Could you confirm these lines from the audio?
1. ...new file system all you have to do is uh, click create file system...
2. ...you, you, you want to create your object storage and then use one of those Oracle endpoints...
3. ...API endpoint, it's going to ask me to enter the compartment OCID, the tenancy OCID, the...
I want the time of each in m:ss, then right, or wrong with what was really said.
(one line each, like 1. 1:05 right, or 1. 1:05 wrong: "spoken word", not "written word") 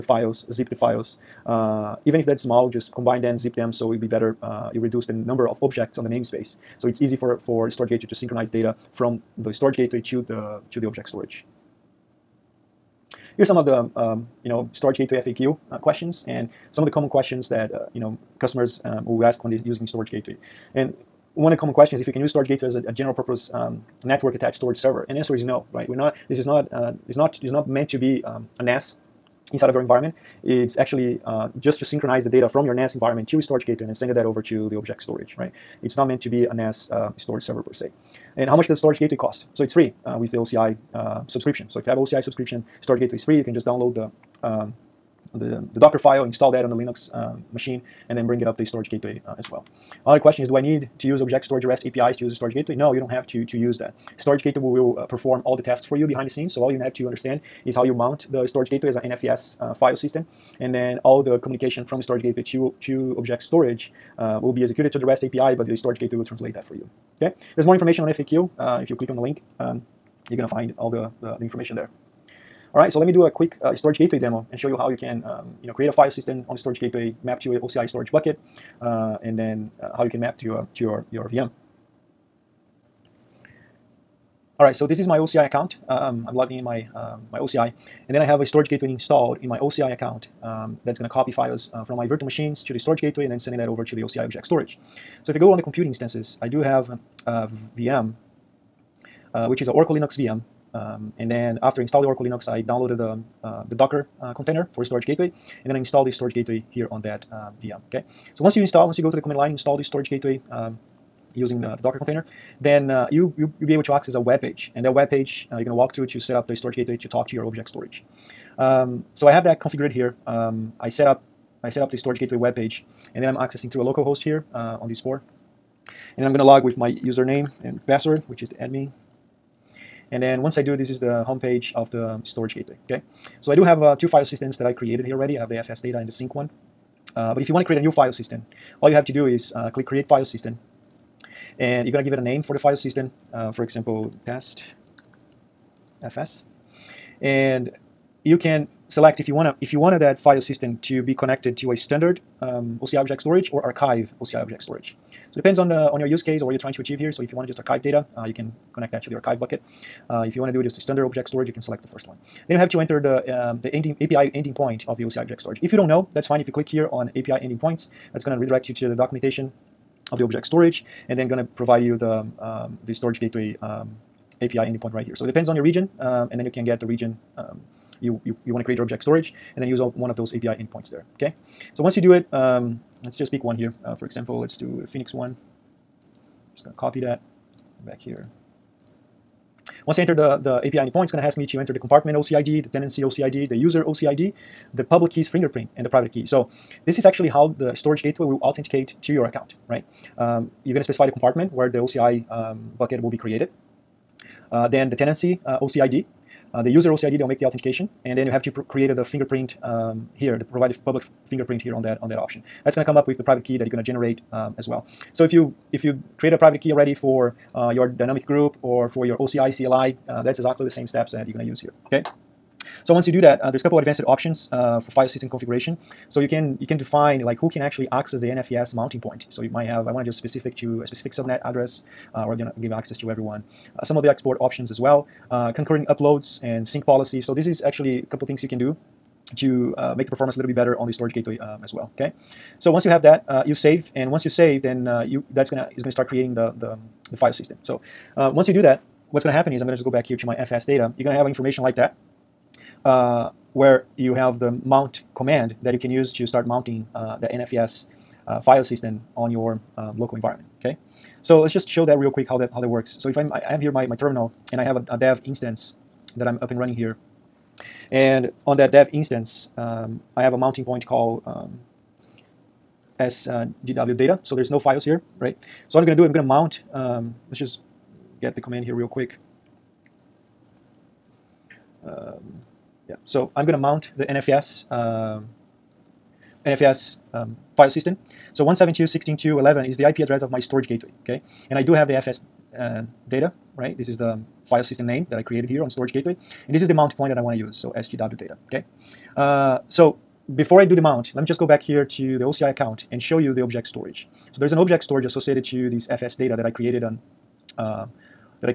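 1. 2:17 right
2. 2:58 wrong: "API", not "Oracle"
3. 3:10 right.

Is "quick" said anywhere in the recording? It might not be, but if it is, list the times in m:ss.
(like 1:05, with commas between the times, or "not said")
1:13, 4:22, 4:38.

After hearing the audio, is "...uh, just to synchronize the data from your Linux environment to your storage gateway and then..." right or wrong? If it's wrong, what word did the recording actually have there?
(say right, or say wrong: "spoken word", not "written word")
wrong: "NAS", not "Linux".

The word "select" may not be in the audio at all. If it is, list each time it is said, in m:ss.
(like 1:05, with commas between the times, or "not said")
2:28, 2:41.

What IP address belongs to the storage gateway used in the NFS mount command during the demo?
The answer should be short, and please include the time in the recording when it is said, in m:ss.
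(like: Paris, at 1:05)
172.16.2.11, at 4:48.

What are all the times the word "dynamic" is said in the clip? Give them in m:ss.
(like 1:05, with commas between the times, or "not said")
3:37.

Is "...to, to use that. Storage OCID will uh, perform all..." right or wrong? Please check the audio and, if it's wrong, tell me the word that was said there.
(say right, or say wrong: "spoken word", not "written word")
wrong: "Gateway", not "OCID".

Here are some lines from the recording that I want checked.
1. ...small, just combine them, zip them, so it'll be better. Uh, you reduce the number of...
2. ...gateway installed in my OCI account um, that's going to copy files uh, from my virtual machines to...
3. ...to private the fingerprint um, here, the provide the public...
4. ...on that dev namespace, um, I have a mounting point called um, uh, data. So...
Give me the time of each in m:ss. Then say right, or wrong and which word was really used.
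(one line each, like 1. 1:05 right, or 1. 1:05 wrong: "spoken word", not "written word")
1. 0:02 right
2. 1:28 right
3. 3:28 wrong: "create", not "private"
4. 4:28 wrong: "instance", not "namespace".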